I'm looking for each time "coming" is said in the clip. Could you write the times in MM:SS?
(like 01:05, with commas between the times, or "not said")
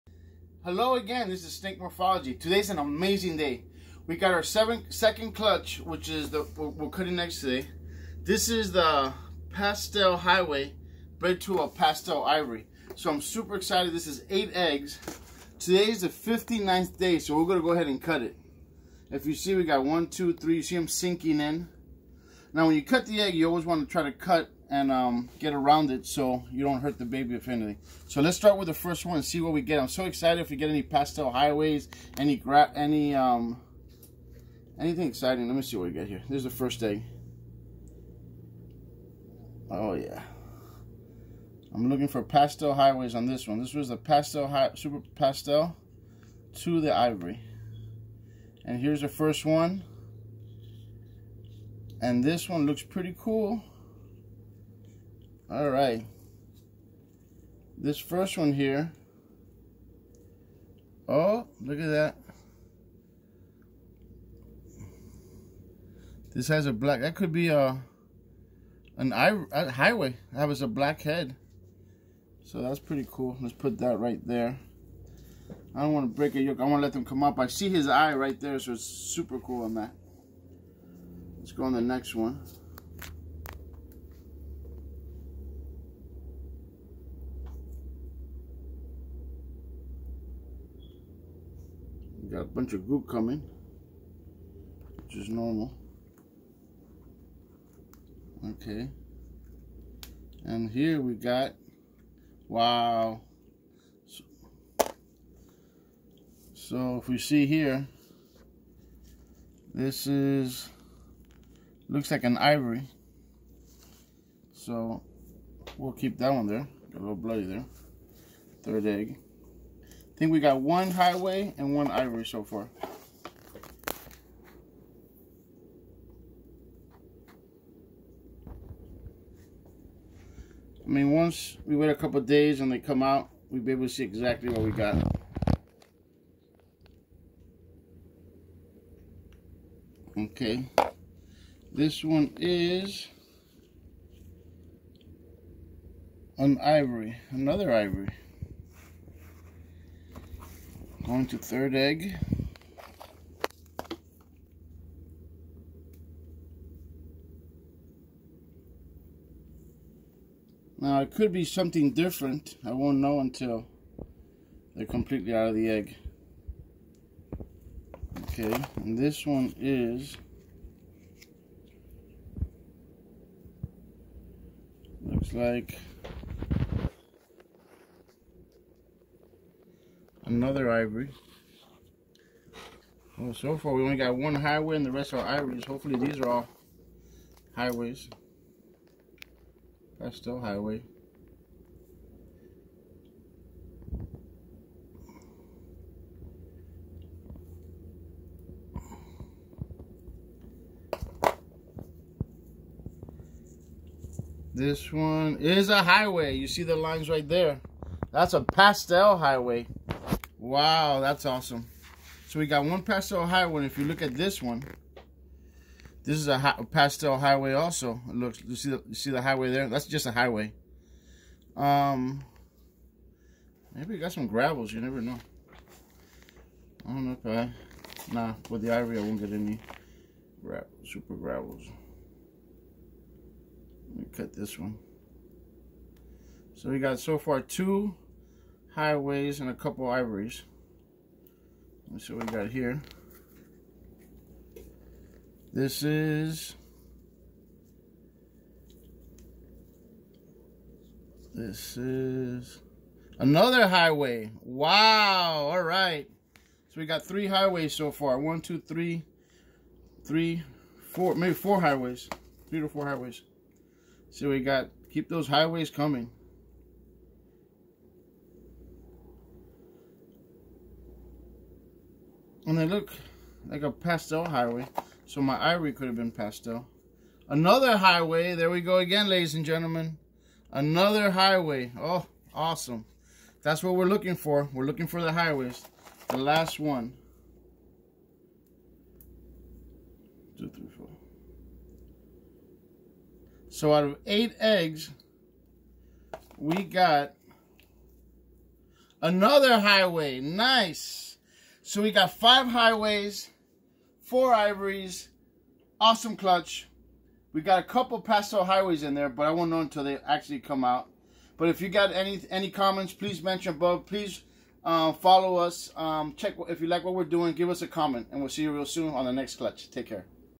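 01:33, 04:25.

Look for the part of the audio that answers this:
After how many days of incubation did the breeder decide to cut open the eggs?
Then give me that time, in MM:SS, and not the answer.
00:16.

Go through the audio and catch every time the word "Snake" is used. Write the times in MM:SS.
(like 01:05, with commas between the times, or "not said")
00:01.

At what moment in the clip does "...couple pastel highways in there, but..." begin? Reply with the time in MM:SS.
05:07.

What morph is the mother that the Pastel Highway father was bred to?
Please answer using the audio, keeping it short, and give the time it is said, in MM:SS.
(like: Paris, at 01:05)
Pastel Ivory, at 00:11.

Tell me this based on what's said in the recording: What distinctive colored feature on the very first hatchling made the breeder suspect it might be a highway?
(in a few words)
black head.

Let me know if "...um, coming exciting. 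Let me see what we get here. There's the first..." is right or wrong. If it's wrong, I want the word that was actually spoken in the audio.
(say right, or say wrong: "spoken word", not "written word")
wrong: "anything", not "coming".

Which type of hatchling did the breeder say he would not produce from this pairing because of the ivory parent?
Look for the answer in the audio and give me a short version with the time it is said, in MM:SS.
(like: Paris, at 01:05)
super gravels, at 03:50.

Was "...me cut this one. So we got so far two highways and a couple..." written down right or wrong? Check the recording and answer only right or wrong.
right.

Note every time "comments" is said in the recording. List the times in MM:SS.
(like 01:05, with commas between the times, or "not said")
05:12, 05:17.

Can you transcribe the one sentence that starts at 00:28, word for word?
So let's start with the first one and see what we get.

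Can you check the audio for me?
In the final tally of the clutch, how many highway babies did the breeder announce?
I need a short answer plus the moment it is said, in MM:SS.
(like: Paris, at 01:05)
5, at 05:02.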